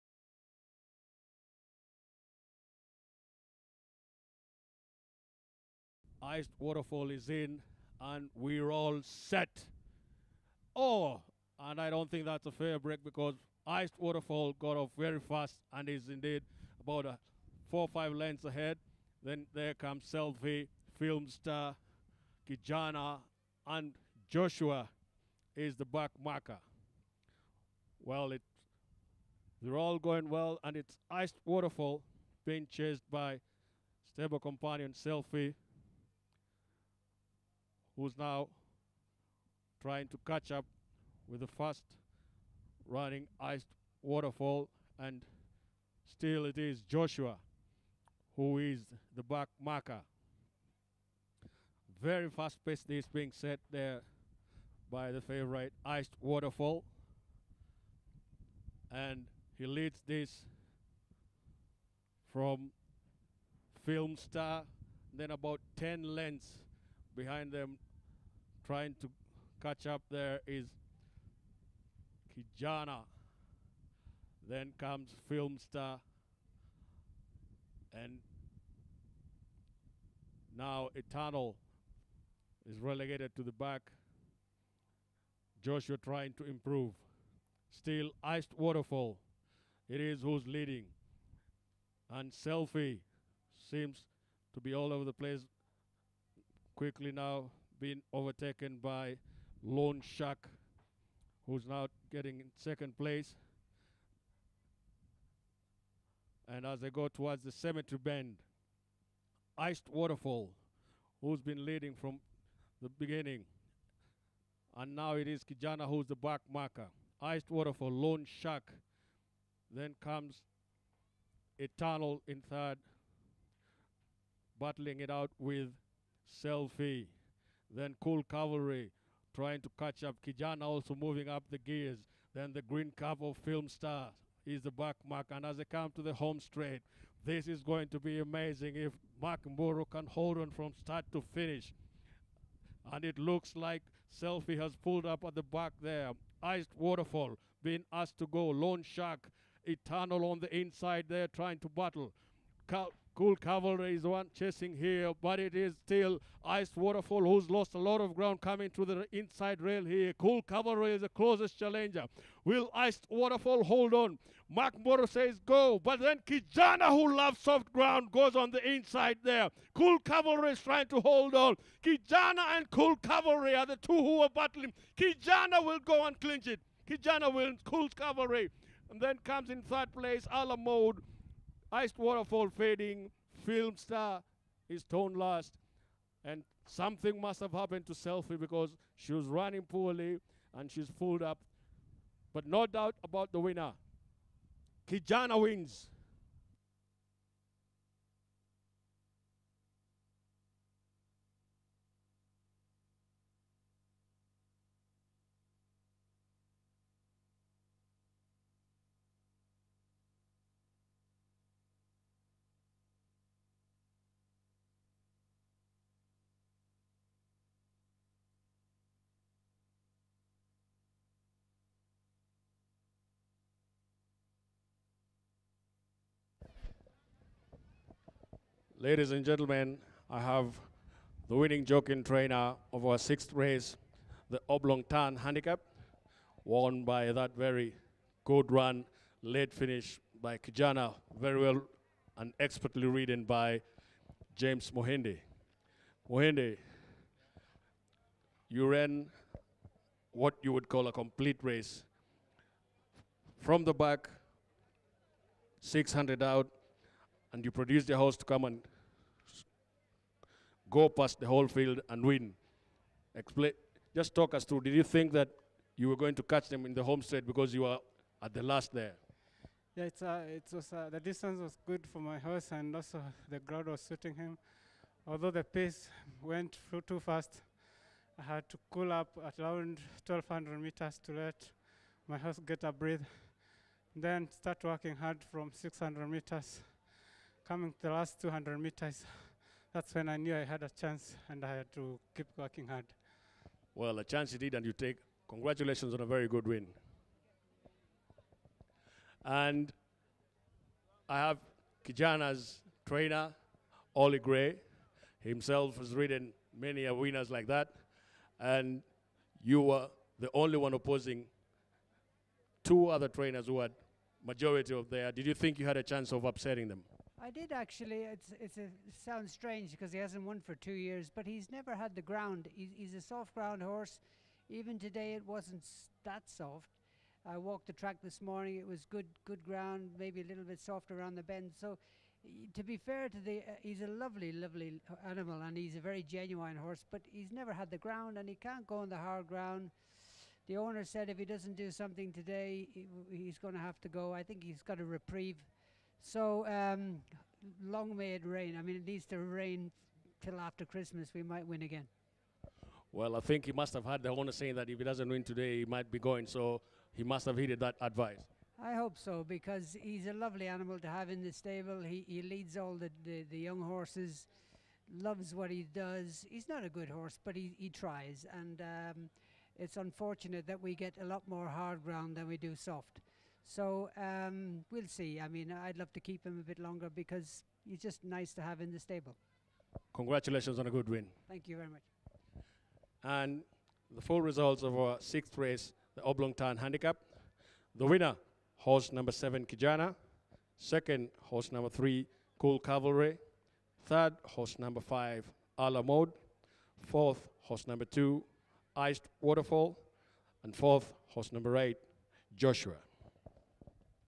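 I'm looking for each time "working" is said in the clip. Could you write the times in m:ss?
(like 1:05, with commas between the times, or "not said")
4:44, 4:52.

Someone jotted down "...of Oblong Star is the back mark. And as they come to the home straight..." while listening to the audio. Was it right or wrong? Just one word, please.
wrong.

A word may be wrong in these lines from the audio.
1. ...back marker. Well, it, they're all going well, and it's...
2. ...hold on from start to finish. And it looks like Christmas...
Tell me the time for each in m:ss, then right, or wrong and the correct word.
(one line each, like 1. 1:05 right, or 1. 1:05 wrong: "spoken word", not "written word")
1. 0:25 right
2. 2:20 wrong: "Selfie", not "Christmas".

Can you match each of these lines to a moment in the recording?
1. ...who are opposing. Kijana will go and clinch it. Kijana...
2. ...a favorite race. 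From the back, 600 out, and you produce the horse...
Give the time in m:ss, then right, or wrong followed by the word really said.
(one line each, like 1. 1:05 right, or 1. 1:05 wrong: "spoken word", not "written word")
1. 2:53 wrong: "battling", not "opposing"
2. 4:10 wrong: "complete", not "favorite".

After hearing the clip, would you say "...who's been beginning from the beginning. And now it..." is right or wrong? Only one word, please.
wrong.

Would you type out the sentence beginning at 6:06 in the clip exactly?
He's not a good horse, but he, he tries.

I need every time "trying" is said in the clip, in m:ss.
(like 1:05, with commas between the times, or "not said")
0:39, 1:08, 1:25, 2:09, 2:31, 2:50.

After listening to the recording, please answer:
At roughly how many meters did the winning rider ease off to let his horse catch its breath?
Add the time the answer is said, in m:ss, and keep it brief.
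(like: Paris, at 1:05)
1,200, at 4:40.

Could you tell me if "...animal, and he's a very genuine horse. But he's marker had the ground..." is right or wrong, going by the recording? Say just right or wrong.
wrong.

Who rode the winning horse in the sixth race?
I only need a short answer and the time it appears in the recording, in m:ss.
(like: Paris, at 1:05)
James Mohinde, at 4:04.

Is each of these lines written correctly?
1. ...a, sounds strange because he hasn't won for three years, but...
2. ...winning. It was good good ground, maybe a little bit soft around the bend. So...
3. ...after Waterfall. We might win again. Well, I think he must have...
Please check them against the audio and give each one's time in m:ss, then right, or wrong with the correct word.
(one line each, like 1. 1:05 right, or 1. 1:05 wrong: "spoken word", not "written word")
1. 5:18 wrong: "two", not "three"
2. 5:28 wrong: "morning", not "winning"
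3. 5:50 wrong: "Christmas", not "Waterfall".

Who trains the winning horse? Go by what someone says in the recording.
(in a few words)
Ollie Gray.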